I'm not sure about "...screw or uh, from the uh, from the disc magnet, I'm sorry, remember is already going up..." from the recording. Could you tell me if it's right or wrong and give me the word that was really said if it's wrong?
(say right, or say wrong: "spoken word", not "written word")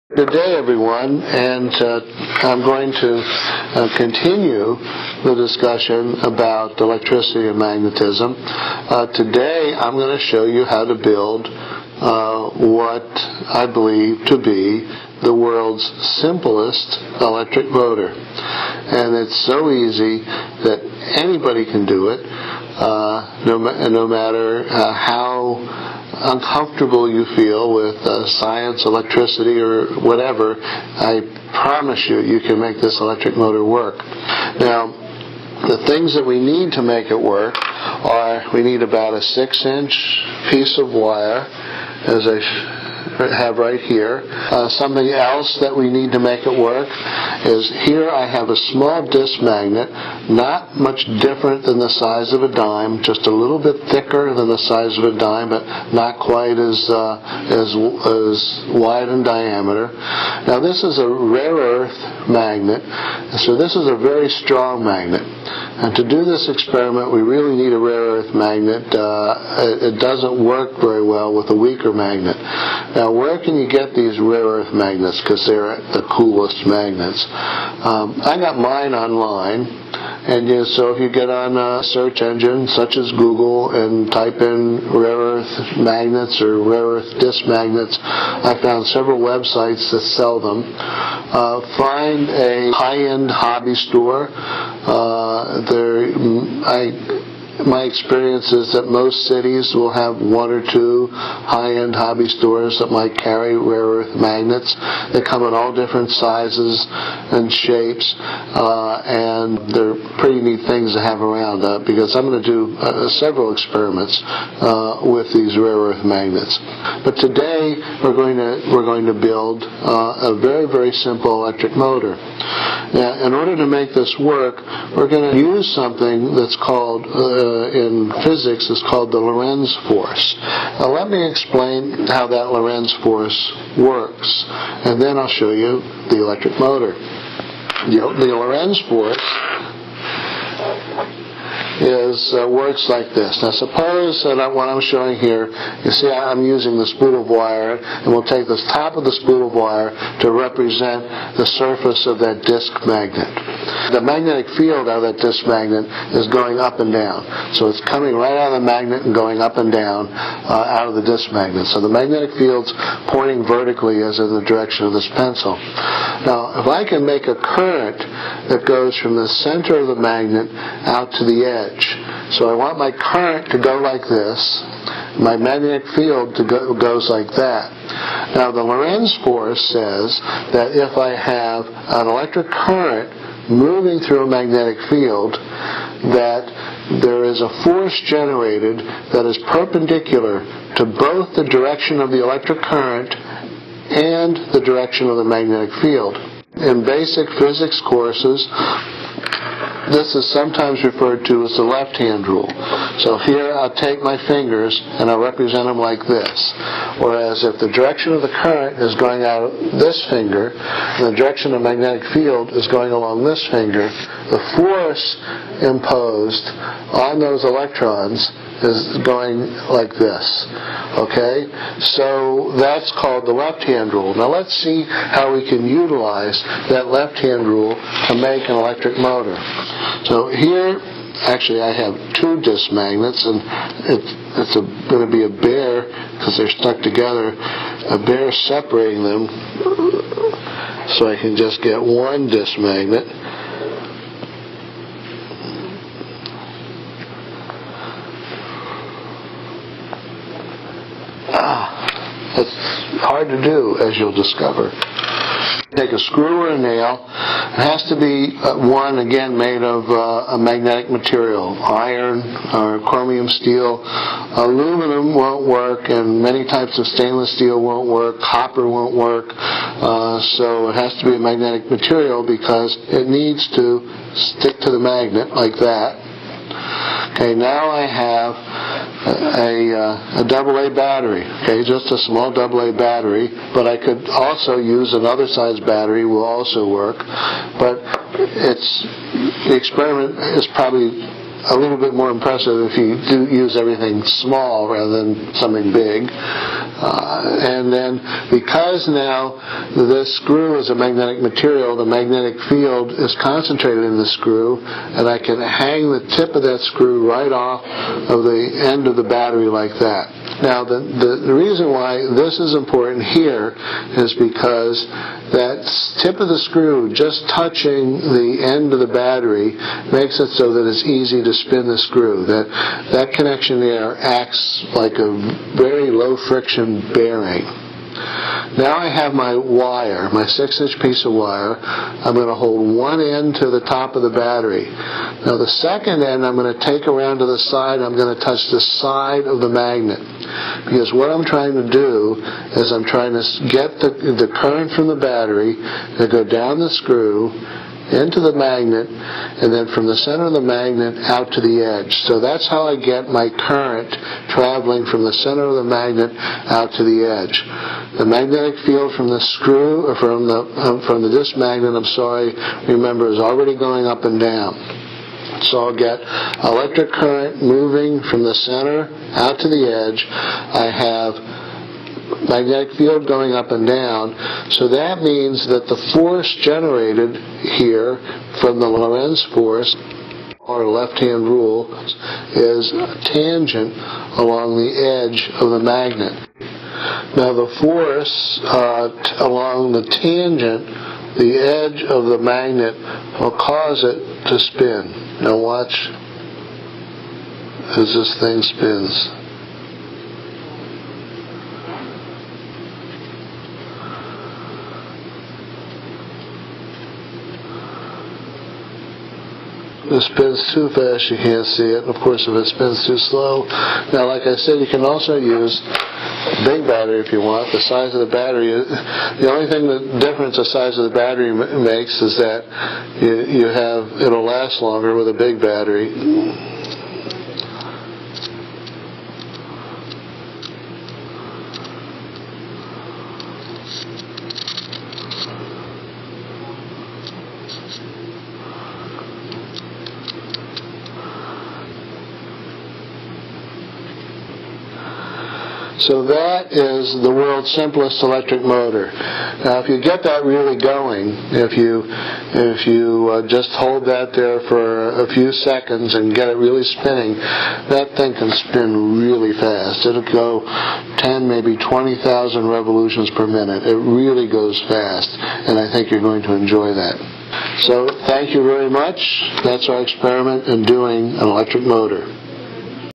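right.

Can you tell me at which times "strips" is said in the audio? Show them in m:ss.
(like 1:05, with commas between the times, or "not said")
not said.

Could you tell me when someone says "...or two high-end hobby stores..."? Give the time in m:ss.
1:40.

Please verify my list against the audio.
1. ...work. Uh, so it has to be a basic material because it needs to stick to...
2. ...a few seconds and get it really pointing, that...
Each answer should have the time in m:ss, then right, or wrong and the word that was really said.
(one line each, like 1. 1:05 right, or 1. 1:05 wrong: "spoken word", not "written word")
1. 4:28 wrong: "magnetic", not "basic"
2. 7:35 wrong: "spinning", not "pointing".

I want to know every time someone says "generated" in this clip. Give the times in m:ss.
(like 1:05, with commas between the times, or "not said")
3:08, 6:16.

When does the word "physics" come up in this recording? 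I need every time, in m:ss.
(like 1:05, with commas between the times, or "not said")
2:08, 3:17.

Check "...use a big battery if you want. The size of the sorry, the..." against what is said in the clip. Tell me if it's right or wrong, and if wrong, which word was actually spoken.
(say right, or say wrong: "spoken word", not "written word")
wrong: "battery", not "sorry".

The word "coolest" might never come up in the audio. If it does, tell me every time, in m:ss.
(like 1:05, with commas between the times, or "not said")
1:16.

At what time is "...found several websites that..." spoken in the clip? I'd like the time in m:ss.
1:28.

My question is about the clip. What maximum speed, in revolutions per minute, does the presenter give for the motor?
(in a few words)
20,000.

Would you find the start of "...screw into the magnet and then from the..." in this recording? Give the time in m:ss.
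5:46.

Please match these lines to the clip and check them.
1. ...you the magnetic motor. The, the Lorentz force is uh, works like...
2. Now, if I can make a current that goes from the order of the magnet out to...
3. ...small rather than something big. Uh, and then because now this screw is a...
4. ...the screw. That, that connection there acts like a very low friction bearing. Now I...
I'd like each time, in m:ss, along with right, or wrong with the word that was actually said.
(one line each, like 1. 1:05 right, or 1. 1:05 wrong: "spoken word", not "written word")
1. 2:15 wrong: "electric", not "magnetic"
2. 2:46 wrong: "center", not "order"
3. 4:54 right
4. 5:21 right.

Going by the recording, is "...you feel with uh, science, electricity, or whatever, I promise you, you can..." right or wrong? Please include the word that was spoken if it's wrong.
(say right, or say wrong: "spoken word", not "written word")
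right.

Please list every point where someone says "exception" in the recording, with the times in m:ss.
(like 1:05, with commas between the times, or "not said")
not said.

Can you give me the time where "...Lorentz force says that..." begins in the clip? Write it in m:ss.
2:58.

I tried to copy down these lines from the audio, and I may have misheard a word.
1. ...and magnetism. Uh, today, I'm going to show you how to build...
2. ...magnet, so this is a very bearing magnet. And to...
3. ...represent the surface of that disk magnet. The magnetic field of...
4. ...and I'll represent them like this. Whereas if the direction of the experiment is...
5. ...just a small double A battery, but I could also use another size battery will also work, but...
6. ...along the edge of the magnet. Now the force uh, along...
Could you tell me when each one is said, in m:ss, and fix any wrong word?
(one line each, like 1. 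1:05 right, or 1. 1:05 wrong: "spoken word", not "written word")
1. 0:07 right
2. 1:02 wrong: "strong", not "bearing"
3. 2:30 right
4. 3:25 wrong: "current", not "experiment"
5. 4:41 right
6. 6:24 right.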